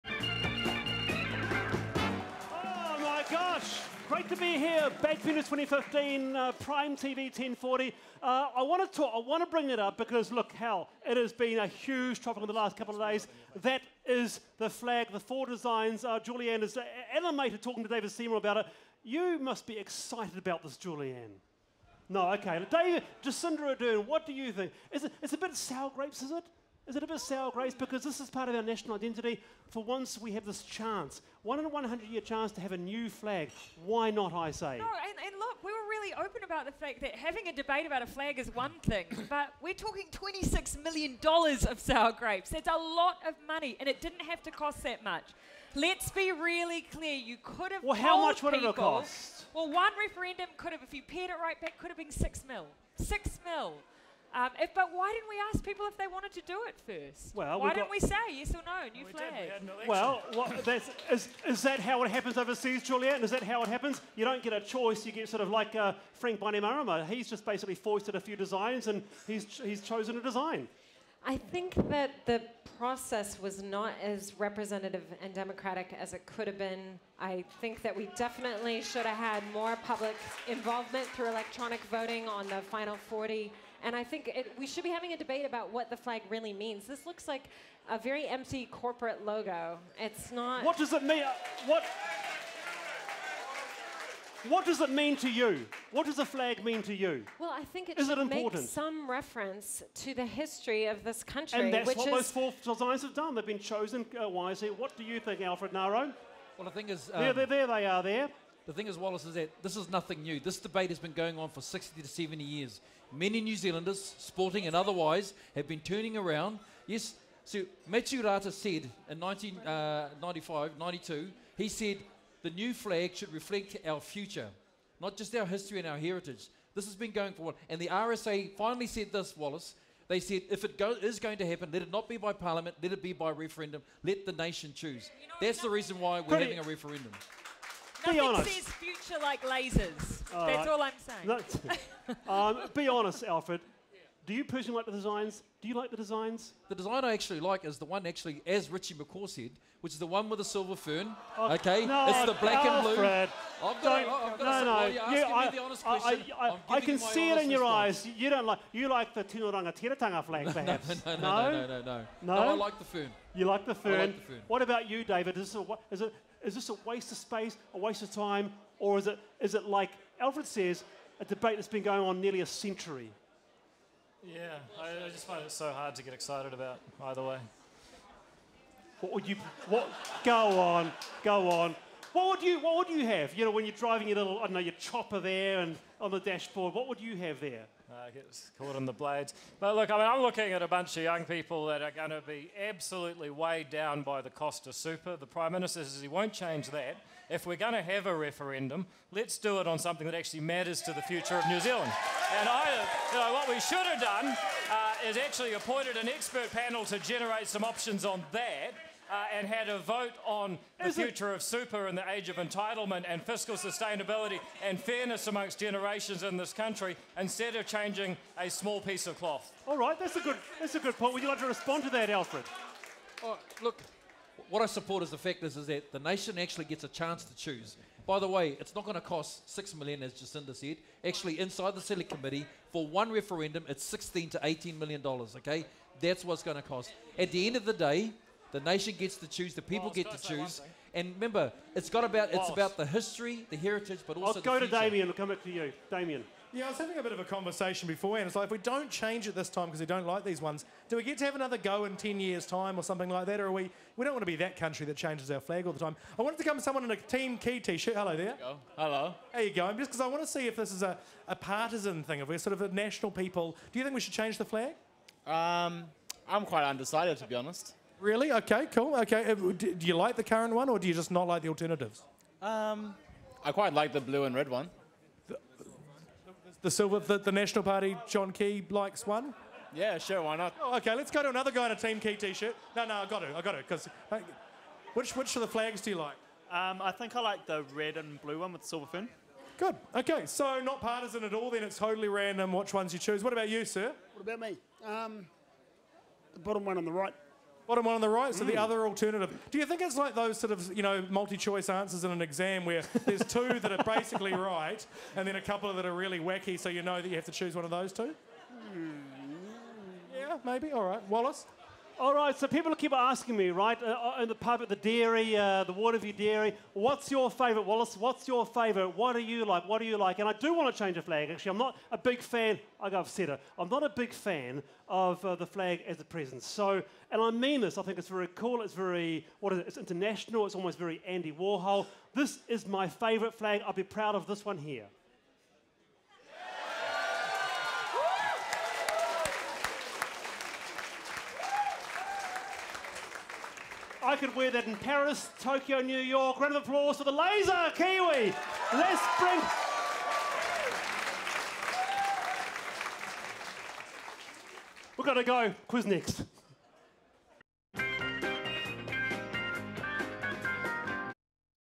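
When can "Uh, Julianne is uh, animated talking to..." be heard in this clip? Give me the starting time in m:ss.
0:16.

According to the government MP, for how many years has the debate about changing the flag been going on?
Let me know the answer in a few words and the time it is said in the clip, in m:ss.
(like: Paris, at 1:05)
60 to 70 years, at 1:51.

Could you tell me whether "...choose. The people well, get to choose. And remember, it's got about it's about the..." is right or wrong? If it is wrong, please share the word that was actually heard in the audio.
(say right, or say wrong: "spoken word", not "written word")
right.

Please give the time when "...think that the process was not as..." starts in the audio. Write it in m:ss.
1:11.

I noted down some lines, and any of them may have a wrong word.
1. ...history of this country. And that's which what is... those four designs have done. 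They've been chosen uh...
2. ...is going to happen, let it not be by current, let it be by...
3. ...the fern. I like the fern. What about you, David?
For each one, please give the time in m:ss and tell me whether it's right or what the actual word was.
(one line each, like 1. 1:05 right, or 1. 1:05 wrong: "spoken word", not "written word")
1. 1:40 right
2. 2:10 wrong: "parliament", not "current"
3. 2:43 right.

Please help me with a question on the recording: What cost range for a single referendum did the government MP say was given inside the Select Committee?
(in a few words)
16 to 18 million dollars.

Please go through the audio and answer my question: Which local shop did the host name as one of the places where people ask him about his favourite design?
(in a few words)
Waterview Dairy.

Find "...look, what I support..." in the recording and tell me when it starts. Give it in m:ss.
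3:43.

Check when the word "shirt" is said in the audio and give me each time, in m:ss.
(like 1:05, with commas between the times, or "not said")
4:17, 4:42.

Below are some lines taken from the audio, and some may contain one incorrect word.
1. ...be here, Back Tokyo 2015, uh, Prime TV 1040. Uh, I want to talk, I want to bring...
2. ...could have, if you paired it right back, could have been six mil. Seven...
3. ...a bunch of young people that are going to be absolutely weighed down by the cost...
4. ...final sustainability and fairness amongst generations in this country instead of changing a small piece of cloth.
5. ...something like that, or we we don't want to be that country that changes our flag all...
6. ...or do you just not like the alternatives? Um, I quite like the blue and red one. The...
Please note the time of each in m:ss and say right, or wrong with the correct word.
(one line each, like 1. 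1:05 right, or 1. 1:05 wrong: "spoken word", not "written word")
1. 0:04 wrong: "Benches", not "Tokyo"
2. 0:50 wrong: "Six", not "Seven"
3. 3:10 right
4. 3:33 wrong: "fiscal", not "final"
5. 4:12 right
6. 4:30 right.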